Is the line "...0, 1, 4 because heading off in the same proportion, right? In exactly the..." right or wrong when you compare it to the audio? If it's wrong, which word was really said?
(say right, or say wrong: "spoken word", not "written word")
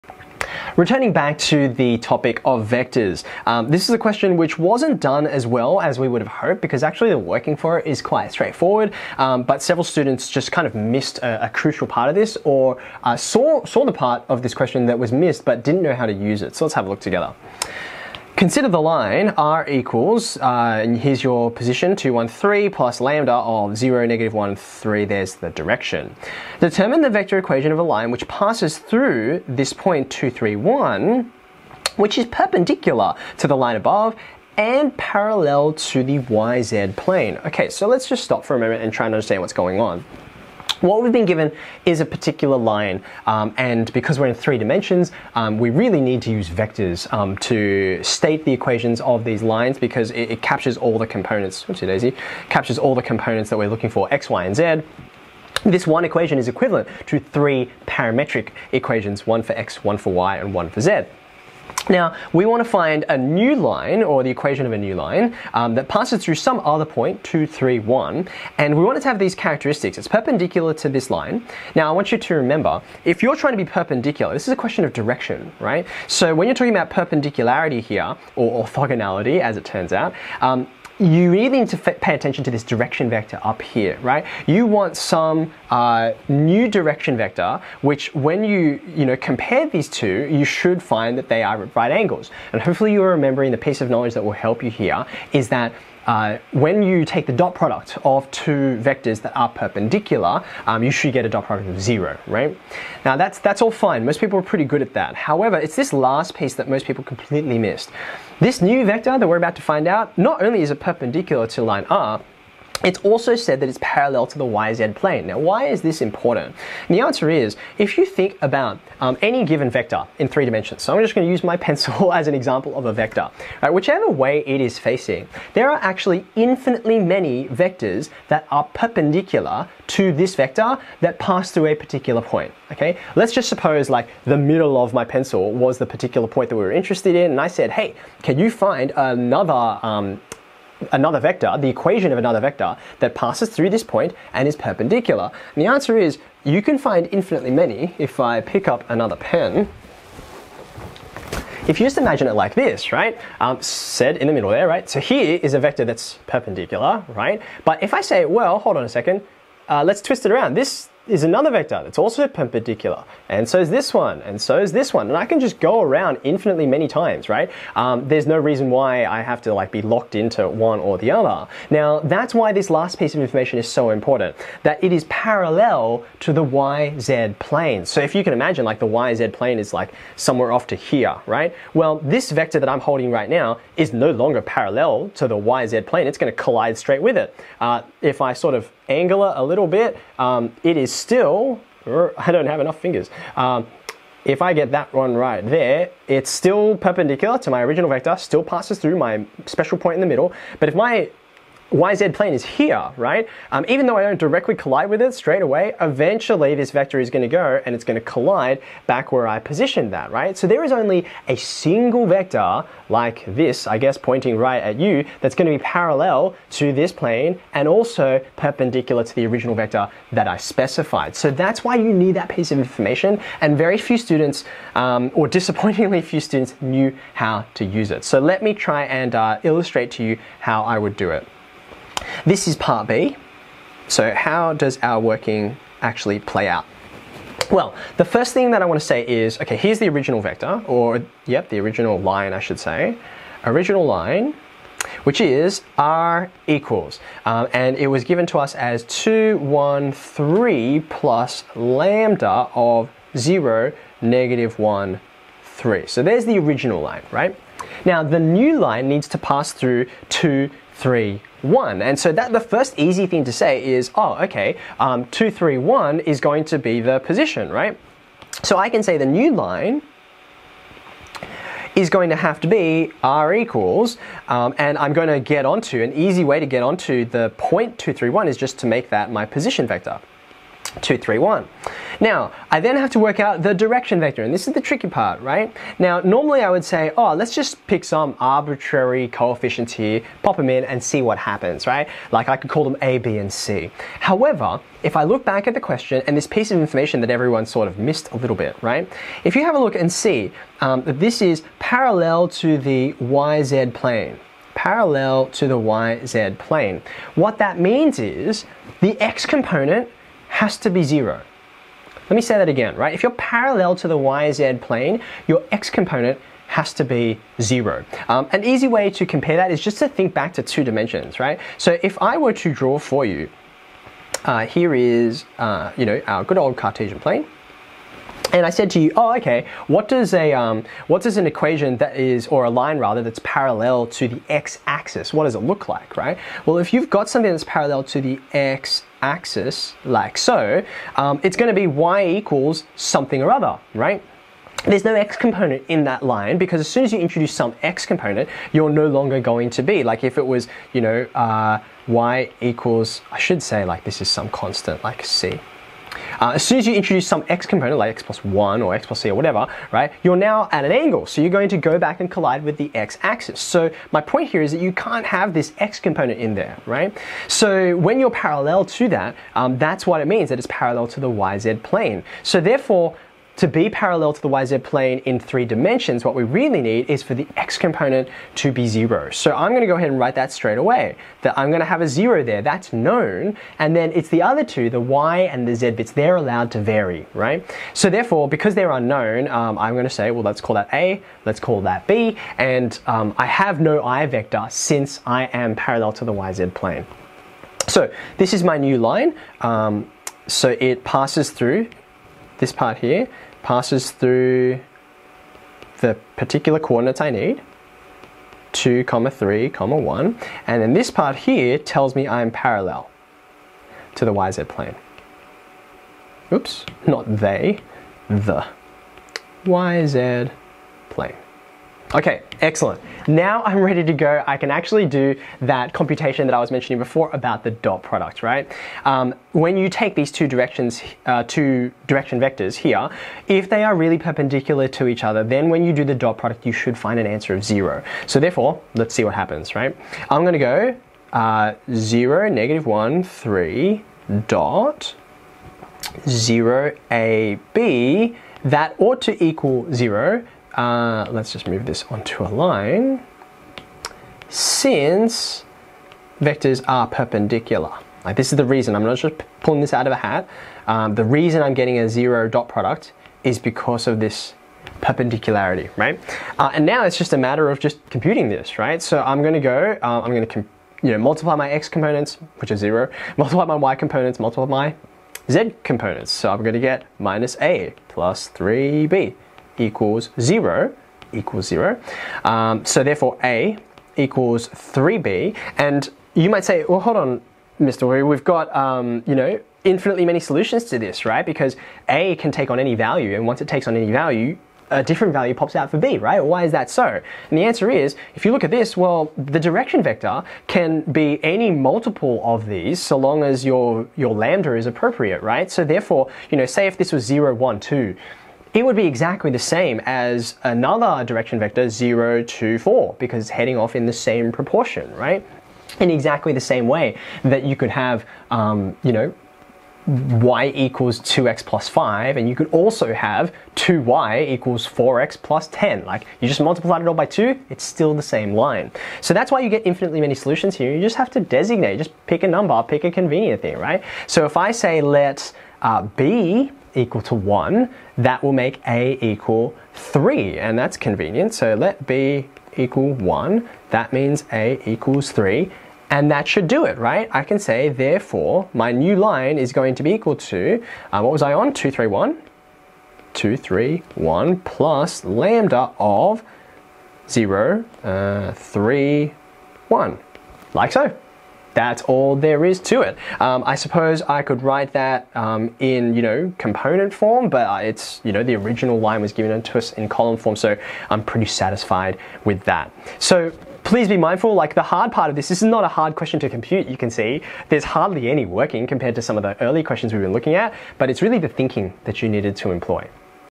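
wrong: "2", not "1".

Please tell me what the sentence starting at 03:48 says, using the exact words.
So let me try and uh, illustrate to you how I would do it.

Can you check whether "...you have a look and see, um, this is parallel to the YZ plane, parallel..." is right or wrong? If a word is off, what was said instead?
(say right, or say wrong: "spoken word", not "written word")
right.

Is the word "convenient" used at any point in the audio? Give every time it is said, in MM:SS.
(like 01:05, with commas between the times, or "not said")
08:52, 09:00.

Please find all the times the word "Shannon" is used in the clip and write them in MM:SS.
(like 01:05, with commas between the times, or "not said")
not said.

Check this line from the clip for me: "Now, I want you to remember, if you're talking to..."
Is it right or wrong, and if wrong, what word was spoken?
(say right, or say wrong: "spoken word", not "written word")
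wrong: "trying", not "talking".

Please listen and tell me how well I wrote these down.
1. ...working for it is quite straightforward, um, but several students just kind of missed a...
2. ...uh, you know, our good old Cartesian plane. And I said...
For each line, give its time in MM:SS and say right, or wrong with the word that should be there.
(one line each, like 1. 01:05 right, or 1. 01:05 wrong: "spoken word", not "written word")
1. 00:07 right
2. 05:25 right.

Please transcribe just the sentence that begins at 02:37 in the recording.
But if I say, well, hold on a second, uh, let's twist it around.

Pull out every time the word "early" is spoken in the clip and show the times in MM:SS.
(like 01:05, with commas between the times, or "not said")
09:39.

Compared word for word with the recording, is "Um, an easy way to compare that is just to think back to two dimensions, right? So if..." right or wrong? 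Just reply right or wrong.
right.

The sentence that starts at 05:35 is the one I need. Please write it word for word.
What does it look like, right?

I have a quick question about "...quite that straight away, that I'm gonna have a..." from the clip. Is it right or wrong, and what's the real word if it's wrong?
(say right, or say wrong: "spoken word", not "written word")
wrong: "write", not "quite".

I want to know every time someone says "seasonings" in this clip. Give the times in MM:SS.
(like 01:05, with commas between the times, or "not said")
not said.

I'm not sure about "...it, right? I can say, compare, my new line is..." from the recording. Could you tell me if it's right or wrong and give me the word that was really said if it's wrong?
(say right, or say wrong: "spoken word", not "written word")
wrong: "therefore", not "compare".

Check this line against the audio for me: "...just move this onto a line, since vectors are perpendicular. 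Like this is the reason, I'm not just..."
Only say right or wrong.
right.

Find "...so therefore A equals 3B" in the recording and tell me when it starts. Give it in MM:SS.
08:02.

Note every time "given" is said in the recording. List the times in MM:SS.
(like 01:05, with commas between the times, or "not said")
00:41, 01:59, 04:08, 09:29.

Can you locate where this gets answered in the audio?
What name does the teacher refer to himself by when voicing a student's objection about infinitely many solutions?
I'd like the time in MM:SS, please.
08:07.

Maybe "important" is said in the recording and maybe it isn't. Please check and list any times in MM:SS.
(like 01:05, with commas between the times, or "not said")
01:56, 02:53.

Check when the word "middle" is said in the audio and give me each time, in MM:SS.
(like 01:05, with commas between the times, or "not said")
02:14, 02:34, 03:20.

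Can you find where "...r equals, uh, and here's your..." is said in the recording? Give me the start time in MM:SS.
00:19.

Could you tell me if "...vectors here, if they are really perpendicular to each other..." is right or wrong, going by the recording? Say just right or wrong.
right.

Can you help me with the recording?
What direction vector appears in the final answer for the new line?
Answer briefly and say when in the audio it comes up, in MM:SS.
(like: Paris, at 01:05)
(0, 3, 1), at 09:17.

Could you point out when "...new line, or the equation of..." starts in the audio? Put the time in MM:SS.
01:03.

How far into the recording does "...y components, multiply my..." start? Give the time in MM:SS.
07:53.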